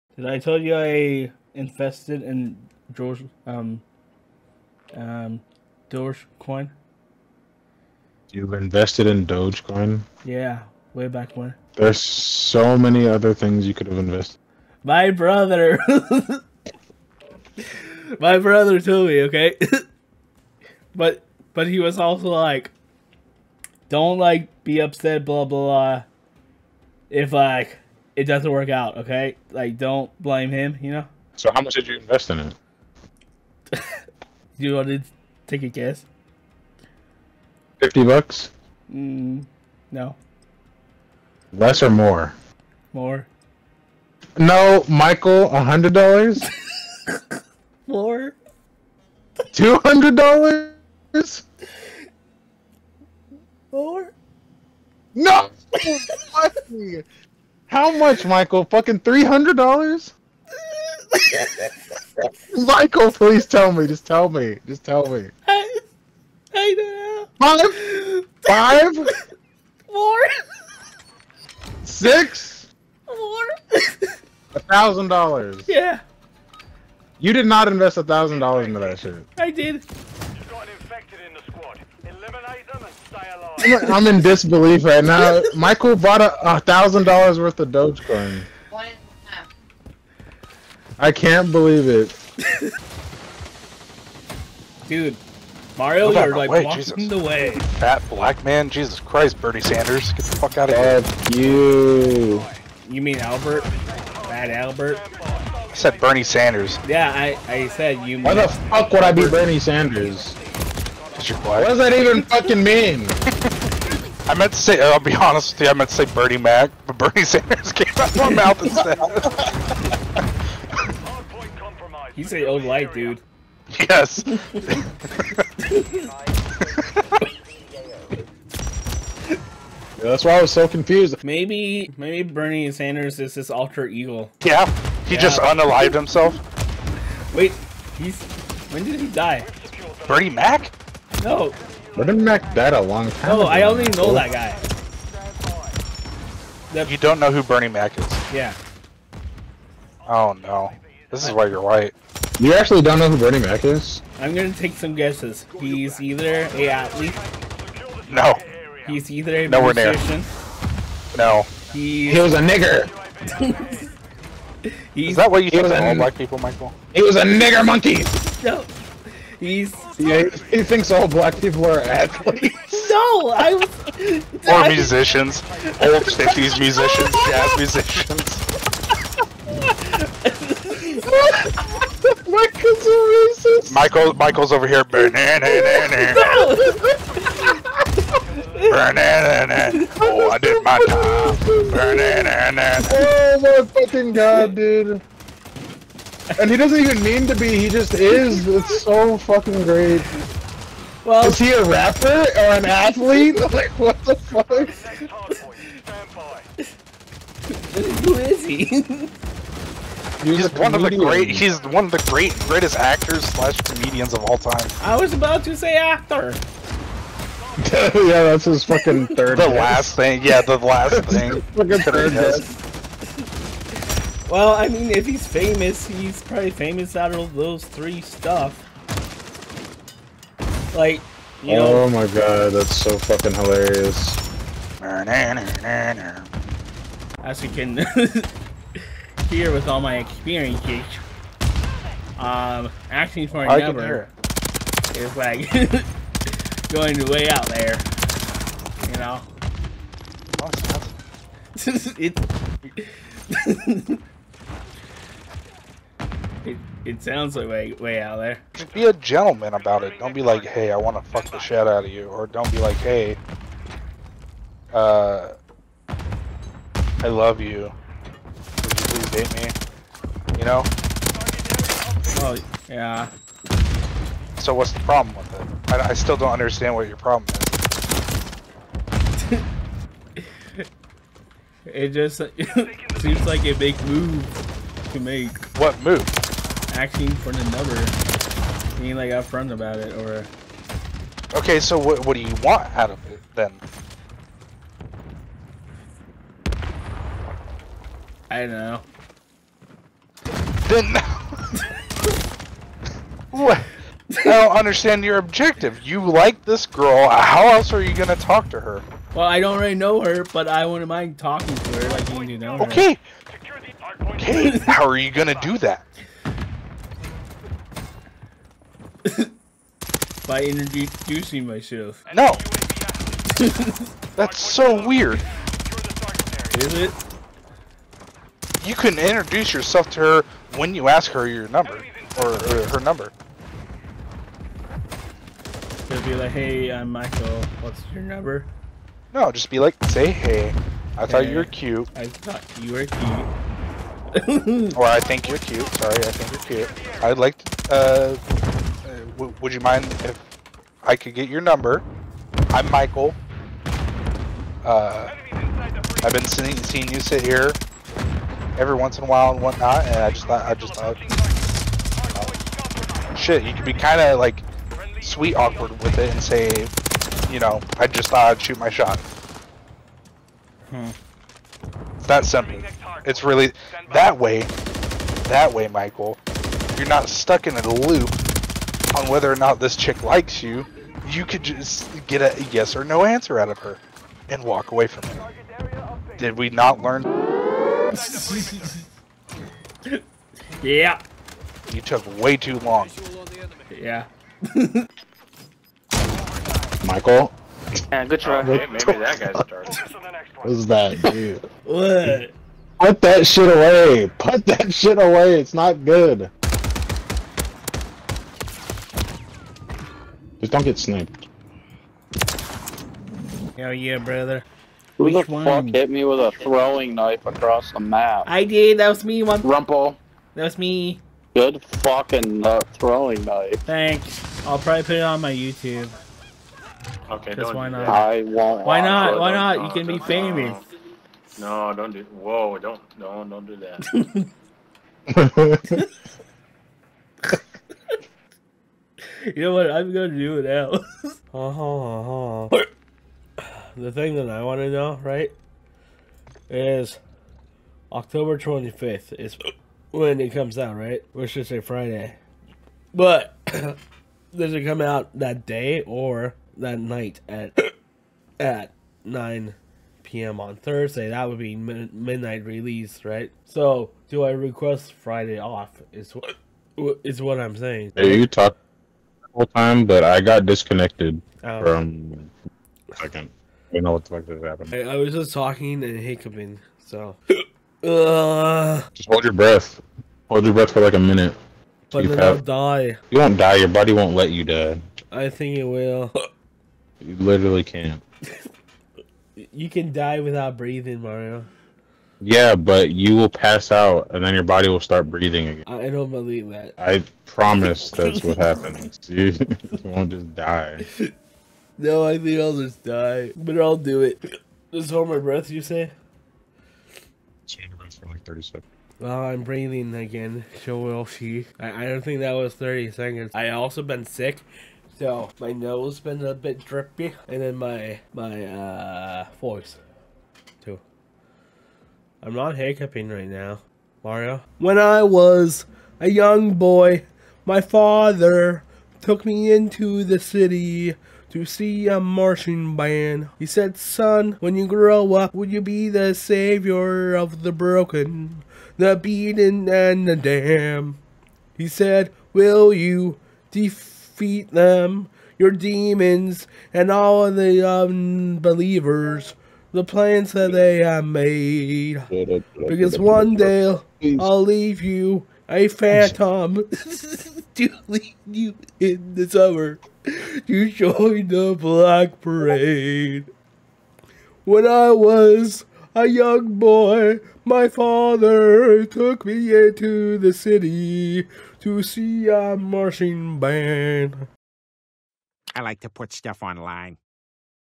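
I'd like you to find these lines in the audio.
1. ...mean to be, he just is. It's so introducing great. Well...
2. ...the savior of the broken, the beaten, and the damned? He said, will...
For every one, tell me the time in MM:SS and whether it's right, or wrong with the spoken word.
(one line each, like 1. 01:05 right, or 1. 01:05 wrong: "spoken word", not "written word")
1. 03:17 wrong: "fucking", not "introducing"
2. 08:55 right.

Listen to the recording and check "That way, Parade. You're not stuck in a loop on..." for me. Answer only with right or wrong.
wrong.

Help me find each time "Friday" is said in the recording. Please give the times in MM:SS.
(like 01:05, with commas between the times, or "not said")
07:31, 07:44.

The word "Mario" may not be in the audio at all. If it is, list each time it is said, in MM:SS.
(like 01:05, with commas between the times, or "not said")
01:35, 08:11, 08:44.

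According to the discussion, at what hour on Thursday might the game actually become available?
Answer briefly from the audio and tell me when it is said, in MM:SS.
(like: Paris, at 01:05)
9 p.m., at 07:39.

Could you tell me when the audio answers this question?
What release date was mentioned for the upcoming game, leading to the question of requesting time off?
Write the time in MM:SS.
07:27.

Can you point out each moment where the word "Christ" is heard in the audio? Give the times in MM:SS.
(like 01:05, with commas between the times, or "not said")
01:38.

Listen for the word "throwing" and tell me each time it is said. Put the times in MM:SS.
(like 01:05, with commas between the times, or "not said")
06:56, 07:02.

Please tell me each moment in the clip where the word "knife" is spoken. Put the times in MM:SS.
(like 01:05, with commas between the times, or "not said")
06:56, 07:03.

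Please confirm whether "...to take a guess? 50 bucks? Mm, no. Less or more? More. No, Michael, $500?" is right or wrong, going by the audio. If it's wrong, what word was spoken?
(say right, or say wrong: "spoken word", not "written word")
wrong: "100", not "500".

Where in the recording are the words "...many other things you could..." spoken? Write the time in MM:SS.
00:12.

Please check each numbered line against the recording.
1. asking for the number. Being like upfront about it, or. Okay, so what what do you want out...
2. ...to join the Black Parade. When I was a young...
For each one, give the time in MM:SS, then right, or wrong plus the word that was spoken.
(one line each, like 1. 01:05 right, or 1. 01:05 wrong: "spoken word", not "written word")
1. 04:46 right
2. 09:20 right.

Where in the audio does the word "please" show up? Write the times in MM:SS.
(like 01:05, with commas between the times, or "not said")
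01:03, 04:28.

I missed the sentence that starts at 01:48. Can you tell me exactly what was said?
Why the fuck would I be Bernie Sanders?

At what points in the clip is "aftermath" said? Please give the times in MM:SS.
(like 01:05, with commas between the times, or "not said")
not said.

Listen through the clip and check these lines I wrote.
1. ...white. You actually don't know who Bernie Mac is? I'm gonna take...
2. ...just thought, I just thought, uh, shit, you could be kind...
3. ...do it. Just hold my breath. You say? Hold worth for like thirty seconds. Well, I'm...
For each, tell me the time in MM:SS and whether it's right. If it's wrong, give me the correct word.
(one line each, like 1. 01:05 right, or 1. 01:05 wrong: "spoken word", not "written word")
1. 02:31 right
2. 06:00 right
3. 08:23 wrong: "breath", not "worth".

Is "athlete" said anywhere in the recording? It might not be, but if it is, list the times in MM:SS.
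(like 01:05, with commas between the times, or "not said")
02:36, 02:51, 03:22.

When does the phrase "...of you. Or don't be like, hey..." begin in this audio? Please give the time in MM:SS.
04:21.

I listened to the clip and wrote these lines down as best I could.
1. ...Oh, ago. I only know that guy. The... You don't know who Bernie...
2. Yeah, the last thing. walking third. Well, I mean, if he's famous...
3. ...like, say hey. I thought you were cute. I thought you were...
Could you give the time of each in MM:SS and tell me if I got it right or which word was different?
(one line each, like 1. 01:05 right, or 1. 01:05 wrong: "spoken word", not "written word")
1. 02:23 right
2. 03:40 wrong: "fucking", not "walking"
3. 05:39 right.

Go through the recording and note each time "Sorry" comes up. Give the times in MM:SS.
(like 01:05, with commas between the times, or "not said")
05:45.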